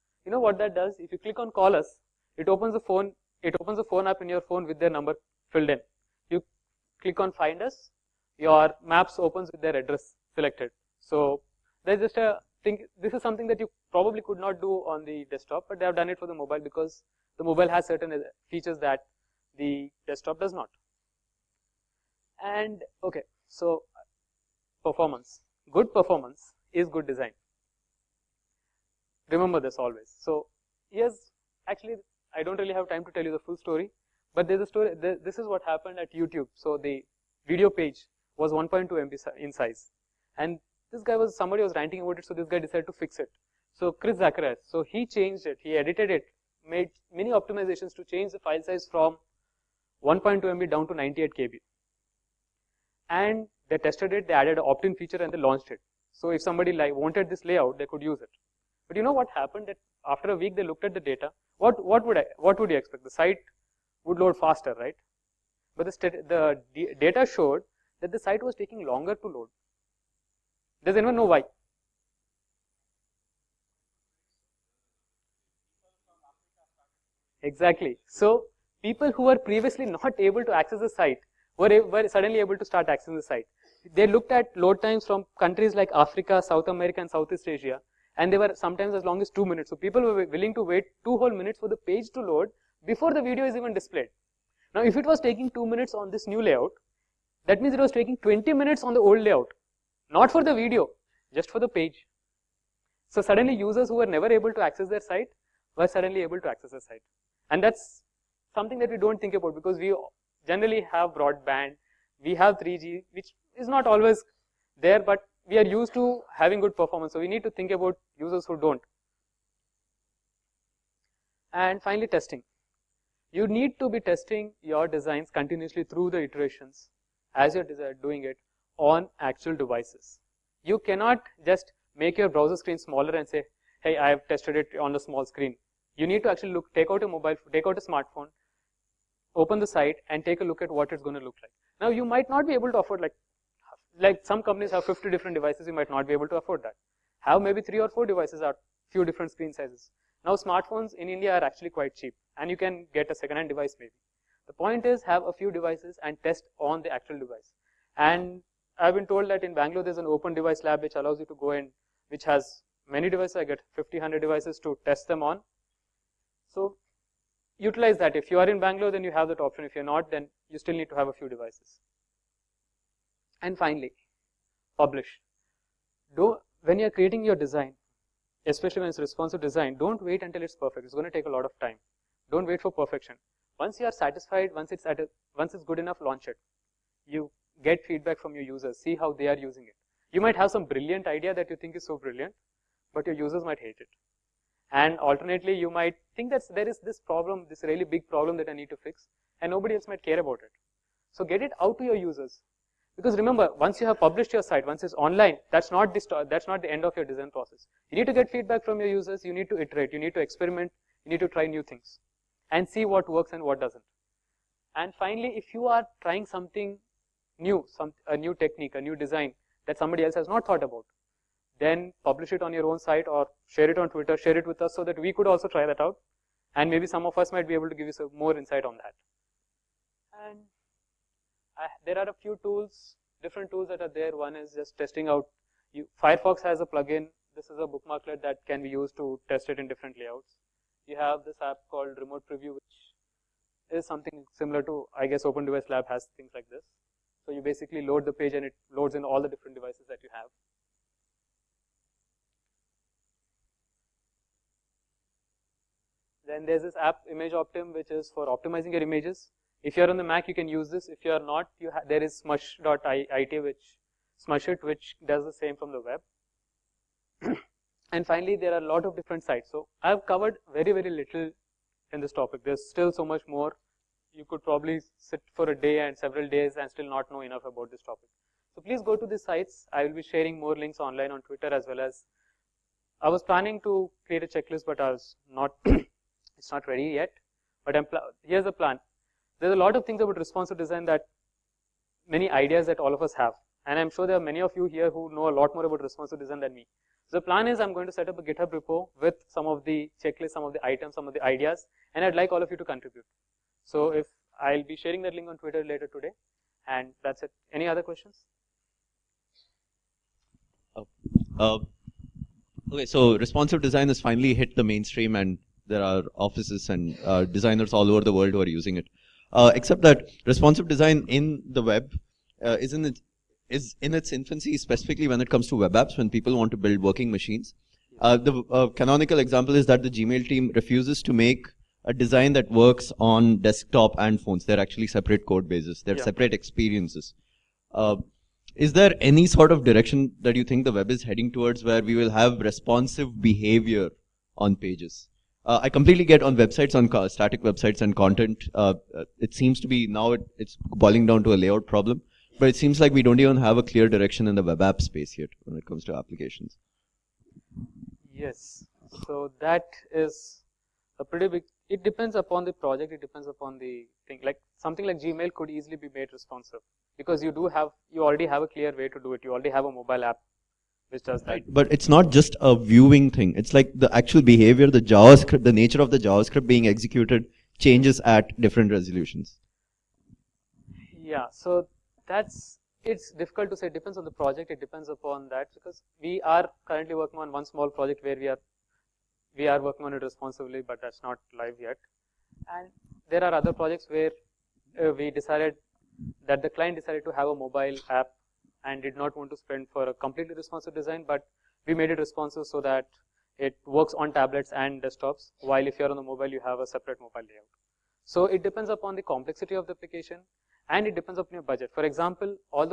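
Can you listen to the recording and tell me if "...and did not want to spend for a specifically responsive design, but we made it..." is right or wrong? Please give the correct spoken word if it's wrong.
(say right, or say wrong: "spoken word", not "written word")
wrong: "completely", not "specifically".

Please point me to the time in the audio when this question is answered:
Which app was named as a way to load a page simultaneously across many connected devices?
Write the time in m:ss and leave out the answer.
4:01.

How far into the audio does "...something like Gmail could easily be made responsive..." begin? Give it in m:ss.
6:04.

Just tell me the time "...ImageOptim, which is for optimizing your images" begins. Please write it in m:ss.
4:17.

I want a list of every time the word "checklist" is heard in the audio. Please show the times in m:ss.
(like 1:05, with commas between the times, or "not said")
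4:44, 5:00.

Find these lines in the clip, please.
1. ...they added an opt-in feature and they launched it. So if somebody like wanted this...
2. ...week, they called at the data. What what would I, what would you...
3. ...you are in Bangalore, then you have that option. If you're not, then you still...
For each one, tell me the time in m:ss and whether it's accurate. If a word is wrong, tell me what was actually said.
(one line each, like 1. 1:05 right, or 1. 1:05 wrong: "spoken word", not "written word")
1. 0:54 right
2. 1:00 wrong: "looked", not "called"
3. 2:48 right.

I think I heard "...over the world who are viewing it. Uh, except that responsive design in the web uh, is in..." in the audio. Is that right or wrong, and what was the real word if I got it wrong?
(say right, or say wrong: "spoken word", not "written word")
wrong: "using", not "viewing".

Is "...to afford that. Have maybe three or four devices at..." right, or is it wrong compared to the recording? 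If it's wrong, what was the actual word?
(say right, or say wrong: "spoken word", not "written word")
right.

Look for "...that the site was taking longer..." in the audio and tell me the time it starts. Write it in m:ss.
1:08.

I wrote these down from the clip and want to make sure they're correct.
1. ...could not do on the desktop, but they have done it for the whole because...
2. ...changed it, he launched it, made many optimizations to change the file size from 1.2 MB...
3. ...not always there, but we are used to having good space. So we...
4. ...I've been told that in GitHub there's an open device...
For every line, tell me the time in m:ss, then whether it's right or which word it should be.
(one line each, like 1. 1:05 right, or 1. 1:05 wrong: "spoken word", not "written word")
1. 0:14 wrong: "mobile", not "whole"
2. 0:45 wrong: "edited", not "launched"
3. 1:53 wrong: "performance", not "space"
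4. 2:38 wrong: "Bangalore", not "GitHub".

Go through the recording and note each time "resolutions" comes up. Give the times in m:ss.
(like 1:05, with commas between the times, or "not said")
6:18.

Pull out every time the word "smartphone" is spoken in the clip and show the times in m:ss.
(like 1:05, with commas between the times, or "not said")
2:17, 2:30.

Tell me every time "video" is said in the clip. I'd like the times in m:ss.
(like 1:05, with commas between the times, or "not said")
0:37, 1:33, 1:40.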